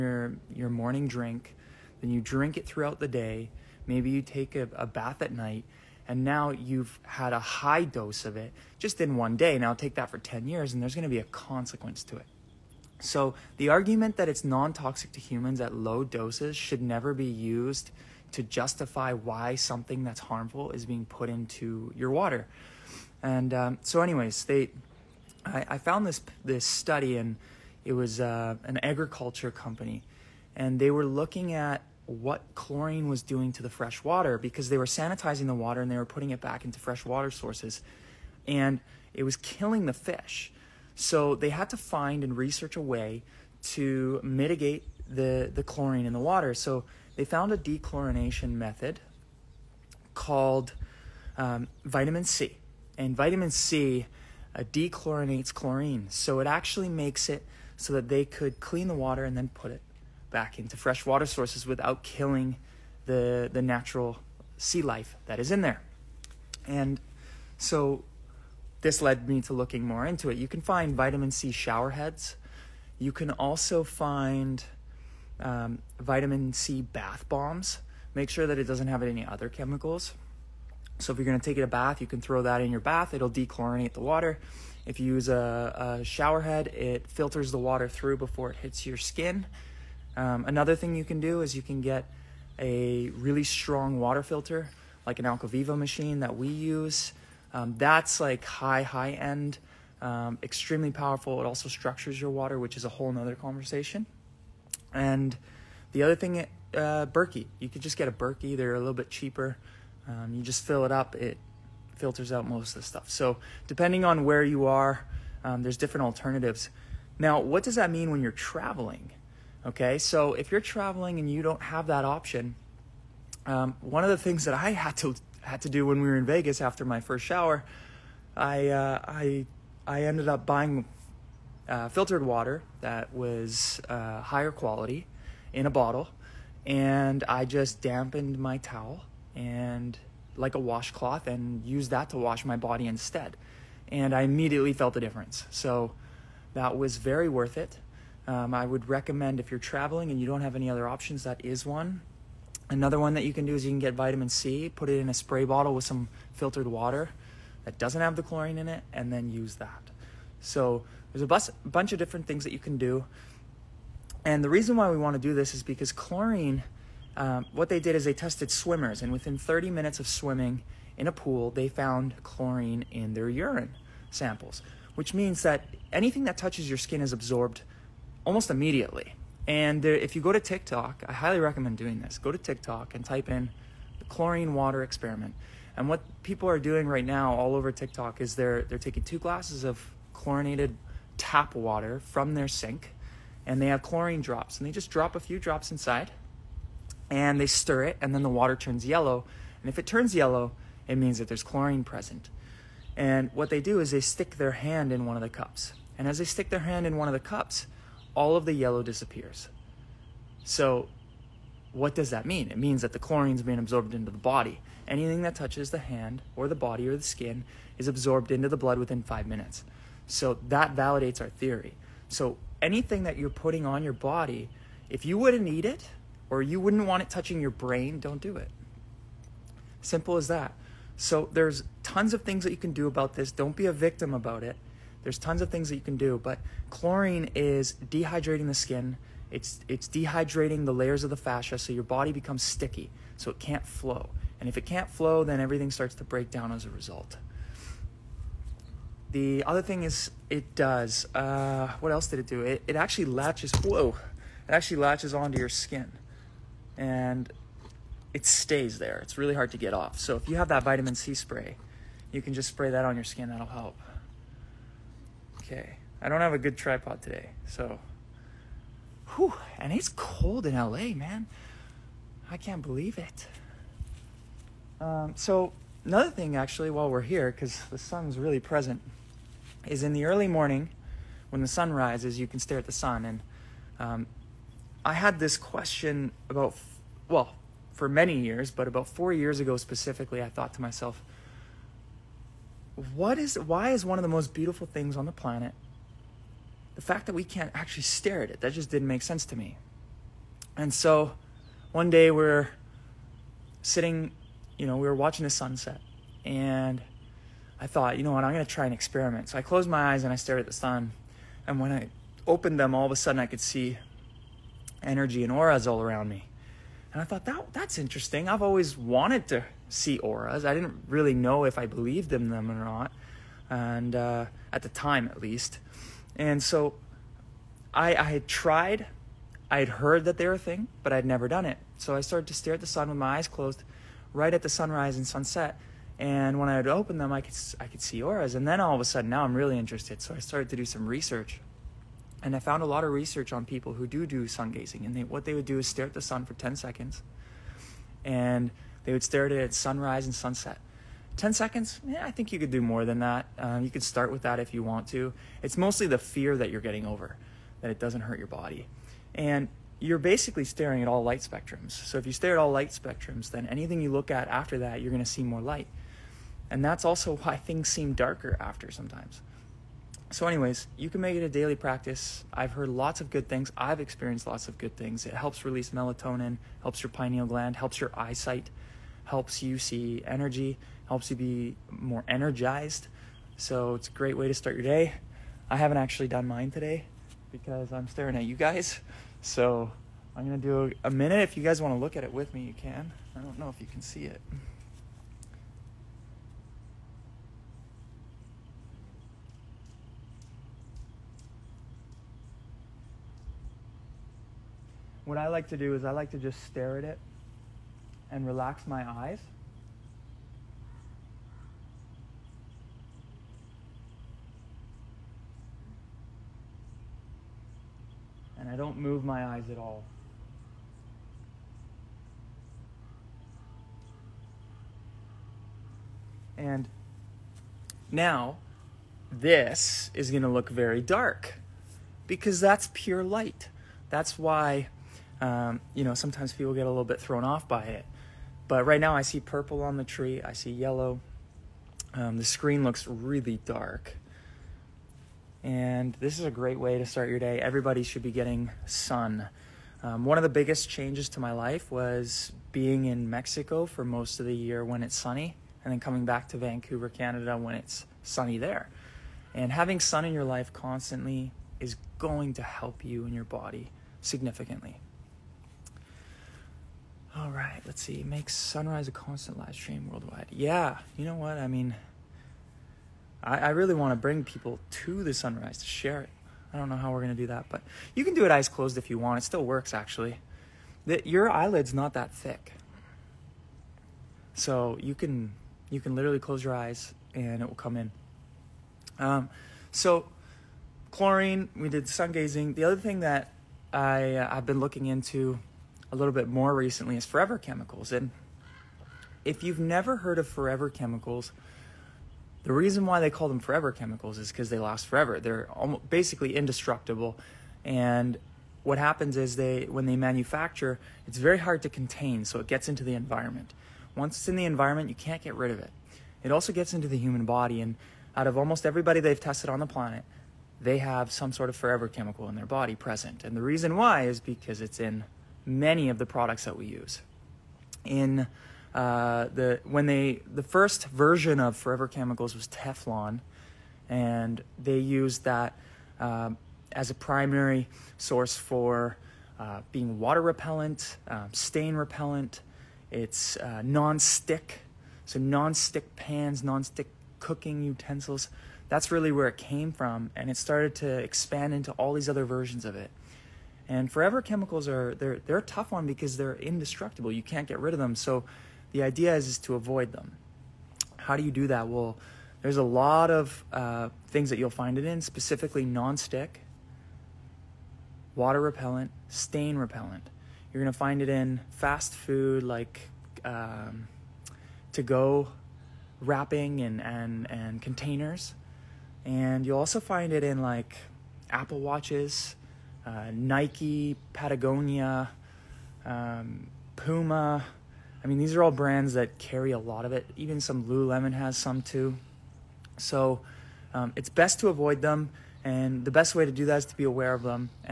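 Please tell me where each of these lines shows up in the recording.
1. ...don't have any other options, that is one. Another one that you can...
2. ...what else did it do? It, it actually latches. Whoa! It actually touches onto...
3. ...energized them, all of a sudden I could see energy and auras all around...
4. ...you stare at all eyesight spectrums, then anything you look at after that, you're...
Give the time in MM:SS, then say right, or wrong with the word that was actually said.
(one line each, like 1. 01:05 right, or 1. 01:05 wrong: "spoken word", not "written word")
1. 02:30 right
2. 04:11 wrong: "latches", not "touches"
3. 05:12 wrong: "opened", not "energized"
4. 06:02 wrong: "light", not "eyesight".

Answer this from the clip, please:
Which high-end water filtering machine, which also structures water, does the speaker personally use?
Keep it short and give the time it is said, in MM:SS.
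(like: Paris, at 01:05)
AlkaViva, at 01:35.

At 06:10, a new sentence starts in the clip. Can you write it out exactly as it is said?
So, anyways, you can make it a daily practice.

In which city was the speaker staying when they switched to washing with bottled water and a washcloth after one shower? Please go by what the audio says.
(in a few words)
Vegas.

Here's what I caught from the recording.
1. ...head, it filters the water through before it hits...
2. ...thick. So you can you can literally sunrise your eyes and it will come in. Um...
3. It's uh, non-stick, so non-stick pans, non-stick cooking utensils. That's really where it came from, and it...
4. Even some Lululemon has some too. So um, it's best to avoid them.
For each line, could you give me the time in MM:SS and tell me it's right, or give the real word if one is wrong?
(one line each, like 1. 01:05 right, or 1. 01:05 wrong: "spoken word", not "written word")
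1. 01:26 right
2. 08:02 wrong: "close", not "sunrise"
3. 09:02 right
4. 09:50 right.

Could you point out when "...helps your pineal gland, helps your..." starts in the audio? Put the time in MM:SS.
06:16.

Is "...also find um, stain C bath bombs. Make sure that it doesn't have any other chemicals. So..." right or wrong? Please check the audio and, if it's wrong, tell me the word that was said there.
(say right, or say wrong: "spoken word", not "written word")
wrong: "vitamin", not "stain".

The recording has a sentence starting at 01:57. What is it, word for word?
Now, what does that mean when you're traveling?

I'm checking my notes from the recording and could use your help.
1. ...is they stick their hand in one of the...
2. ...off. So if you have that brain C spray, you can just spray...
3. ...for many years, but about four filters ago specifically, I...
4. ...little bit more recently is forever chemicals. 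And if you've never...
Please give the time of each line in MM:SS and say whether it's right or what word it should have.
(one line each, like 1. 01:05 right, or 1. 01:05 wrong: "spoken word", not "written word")
1. 03:23 right
2. 04:19 wrong: "vitamin", not "brain"
3. 04:47 wrong: "years", not "filters"
4. 08:15 right.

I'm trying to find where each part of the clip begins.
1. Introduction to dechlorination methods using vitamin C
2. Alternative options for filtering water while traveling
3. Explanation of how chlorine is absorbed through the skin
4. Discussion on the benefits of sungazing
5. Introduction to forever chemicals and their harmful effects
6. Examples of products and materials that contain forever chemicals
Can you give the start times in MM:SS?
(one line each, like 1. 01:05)
1. 00:40
2. 02:15
3. 03:22
4. 04:55
5. 08:26
6. 09:38.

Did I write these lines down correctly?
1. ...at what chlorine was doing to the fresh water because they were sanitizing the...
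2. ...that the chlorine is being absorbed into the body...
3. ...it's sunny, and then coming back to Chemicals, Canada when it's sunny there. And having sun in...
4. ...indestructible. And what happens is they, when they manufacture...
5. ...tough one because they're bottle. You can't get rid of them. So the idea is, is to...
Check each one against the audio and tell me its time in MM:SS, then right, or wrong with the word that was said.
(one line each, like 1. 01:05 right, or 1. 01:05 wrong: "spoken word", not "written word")
1. 00:31 right
2. 03:32 right
3. 07:34 wrong: "Vancouver", not "Chemicals"
4. 08:26 right
5. 09:15 wrong: "indestructible", not "bottle".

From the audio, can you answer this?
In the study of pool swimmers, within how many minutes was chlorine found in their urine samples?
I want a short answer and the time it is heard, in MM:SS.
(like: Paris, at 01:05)
30 minutes, at 02:49.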